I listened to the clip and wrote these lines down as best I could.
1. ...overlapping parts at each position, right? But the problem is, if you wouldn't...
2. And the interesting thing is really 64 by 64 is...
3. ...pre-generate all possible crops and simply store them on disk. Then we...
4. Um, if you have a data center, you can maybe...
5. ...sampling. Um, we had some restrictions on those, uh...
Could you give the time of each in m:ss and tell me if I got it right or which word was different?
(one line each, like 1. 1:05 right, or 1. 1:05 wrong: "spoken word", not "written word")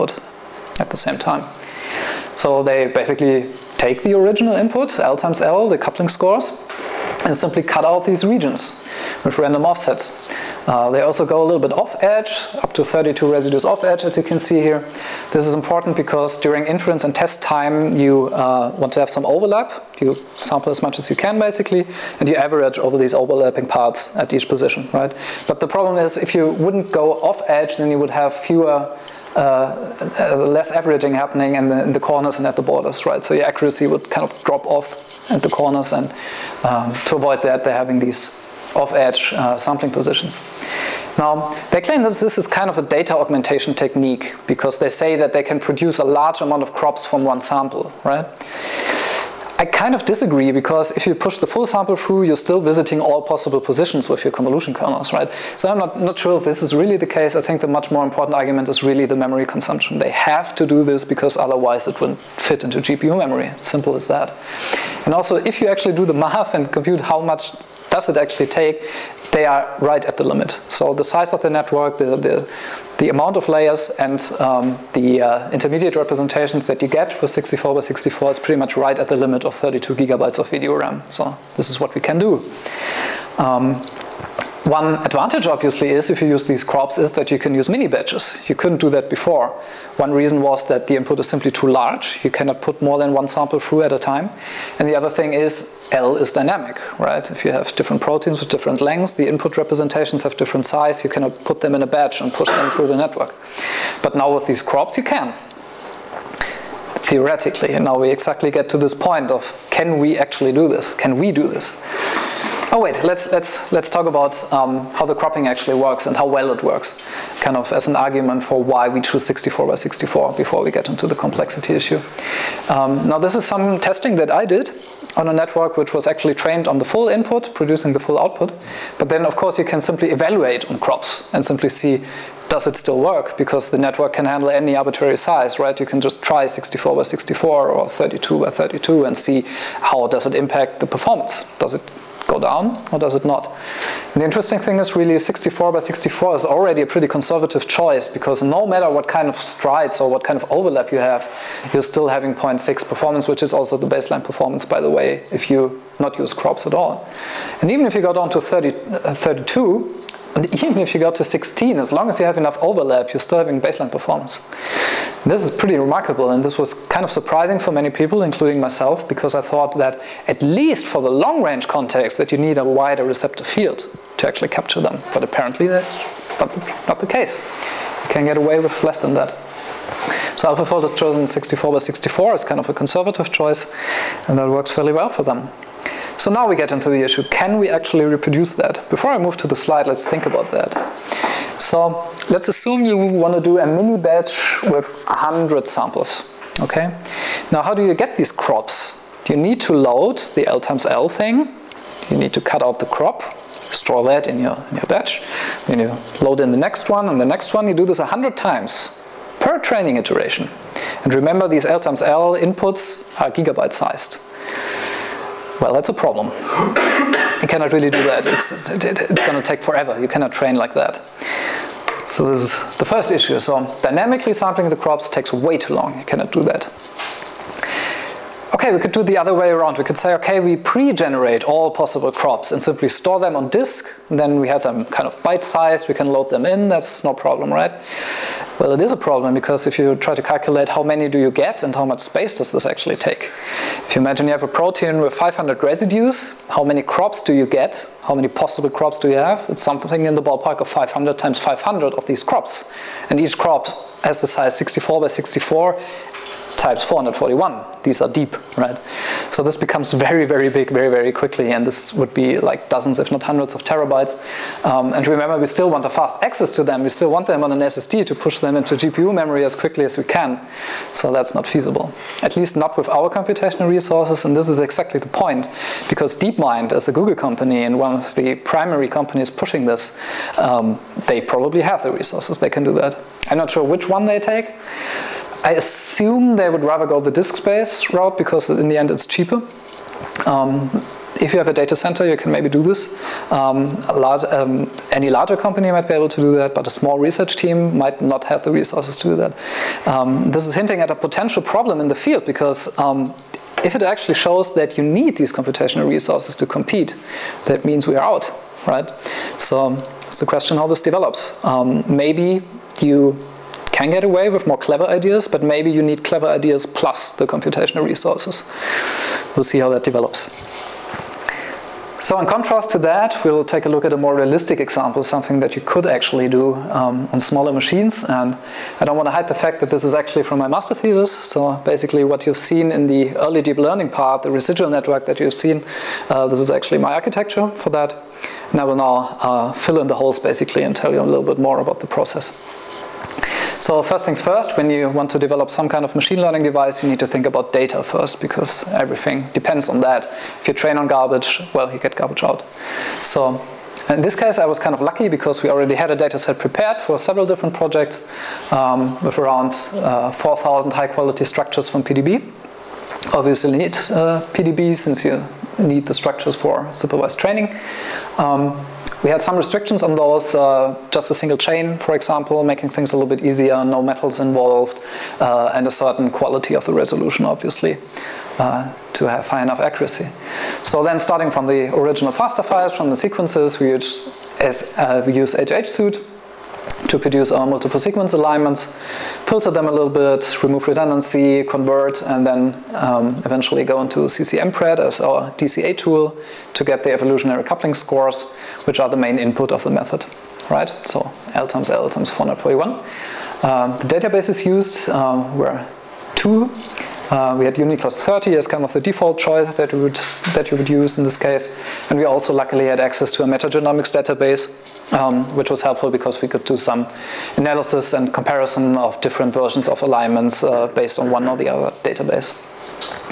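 1. 0:23 right
2. 2:24 right
3. 3:50 right
4. 4:50 right
5. 6:07 wrong: "training", not "sampling".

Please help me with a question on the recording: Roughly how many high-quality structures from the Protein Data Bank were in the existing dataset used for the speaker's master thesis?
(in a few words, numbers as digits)
4,000.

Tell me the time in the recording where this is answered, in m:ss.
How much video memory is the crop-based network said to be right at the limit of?
1:19.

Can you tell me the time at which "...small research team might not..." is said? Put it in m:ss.
4:56.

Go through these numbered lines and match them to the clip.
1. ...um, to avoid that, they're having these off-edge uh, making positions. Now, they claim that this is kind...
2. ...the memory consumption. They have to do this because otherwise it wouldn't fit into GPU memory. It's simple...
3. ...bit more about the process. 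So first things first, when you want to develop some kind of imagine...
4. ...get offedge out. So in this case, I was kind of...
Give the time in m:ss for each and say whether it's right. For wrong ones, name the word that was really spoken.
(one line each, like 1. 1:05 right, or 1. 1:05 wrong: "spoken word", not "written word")
1. 0:36 wrong: "sampling", not "making"
2. 0:59 right
3. 5:41 wrong: "machine", not "imagine"
4. 5:51 wrong: "garbage", not "offedge".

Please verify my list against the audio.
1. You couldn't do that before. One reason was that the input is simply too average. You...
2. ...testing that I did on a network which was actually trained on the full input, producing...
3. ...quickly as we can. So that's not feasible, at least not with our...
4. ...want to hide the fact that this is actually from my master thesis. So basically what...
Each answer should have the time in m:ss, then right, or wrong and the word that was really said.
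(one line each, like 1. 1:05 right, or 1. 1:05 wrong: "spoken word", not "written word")
1. 1:28 wrong: "large", not "average"
2. 2:03 right
3. 4:29 right
4. 5:28 right.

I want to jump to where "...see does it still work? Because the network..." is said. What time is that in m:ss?
2:11.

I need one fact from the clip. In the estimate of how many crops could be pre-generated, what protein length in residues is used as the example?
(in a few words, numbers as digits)
500.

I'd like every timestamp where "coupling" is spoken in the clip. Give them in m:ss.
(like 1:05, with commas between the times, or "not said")
0:05, 6:37.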